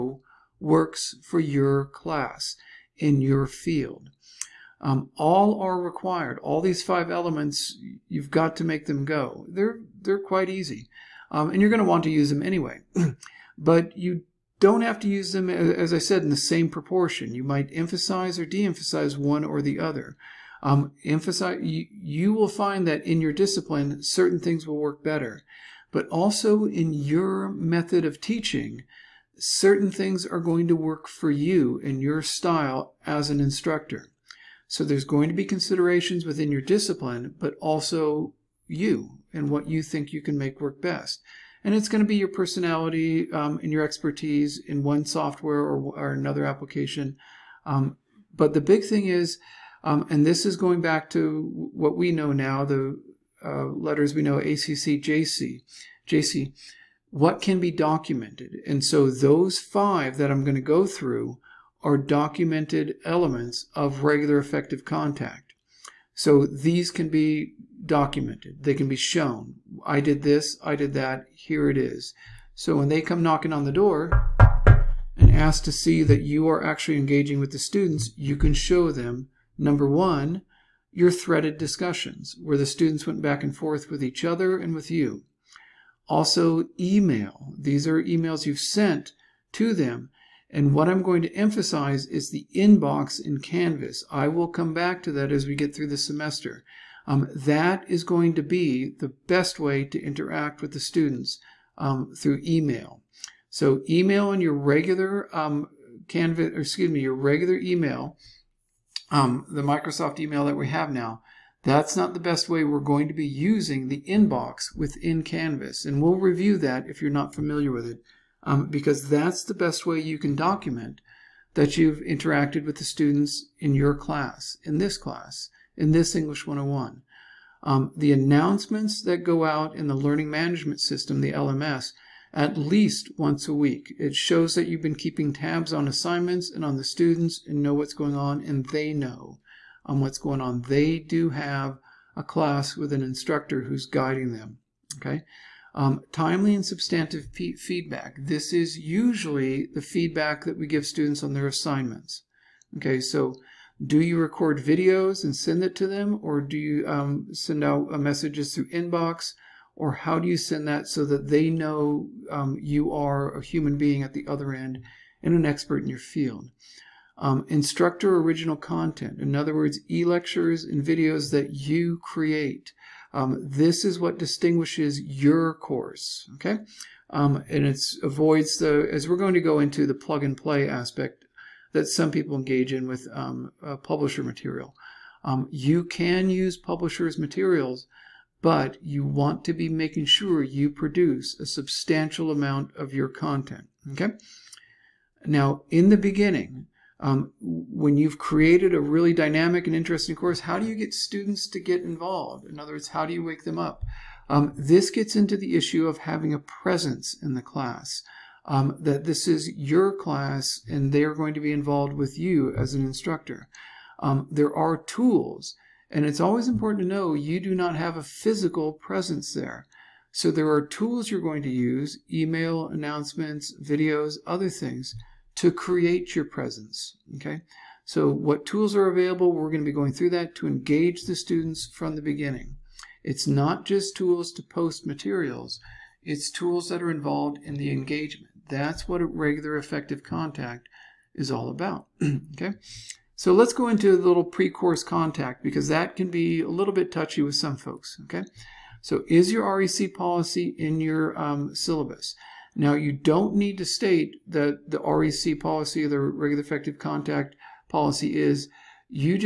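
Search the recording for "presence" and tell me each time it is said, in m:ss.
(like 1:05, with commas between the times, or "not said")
3:26, 3:38, 3:46.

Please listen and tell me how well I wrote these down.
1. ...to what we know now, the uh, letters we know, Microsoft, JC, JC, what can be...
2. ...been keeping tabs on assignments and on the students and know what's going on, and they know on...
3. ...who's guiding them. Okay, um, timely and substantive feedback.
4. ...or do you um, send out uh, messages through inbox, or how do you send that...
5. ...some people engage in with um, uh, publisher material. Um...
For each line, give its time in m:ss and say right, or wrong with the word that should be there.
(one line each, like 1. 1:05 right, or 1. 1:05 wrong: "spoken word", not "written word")
1. 0:51 wrong: "ACC", not "Microsoft"
2. 2:14 right
3. 2:23 right
4. 2:36 right
5. 3:01 right.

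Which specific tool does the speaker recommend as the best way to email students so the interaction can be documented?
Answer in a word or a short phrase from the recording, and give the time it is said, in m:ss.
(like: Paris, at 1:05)
Inbox in Canvas, at 1:32.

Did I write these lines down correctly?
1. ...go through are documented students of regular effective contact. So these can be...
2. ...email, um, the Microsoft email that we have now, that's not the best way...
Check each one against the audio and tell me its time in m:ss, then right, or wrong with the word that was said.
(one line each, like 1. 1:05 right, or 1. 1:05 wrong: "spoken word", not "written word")
1. 1:00 wrong: "elements", not "students"
2. 1:47 right.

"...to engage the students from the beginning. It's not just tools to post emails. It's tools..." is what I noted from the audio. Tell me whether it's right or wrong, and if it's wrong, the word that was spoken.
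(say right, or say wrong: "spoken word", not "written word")
wrong: "materials", not "emails".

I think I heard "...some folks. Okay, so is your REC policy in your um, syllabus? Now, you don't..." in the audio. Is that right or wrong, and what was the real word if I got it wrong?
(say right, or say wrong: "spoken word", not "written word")
right.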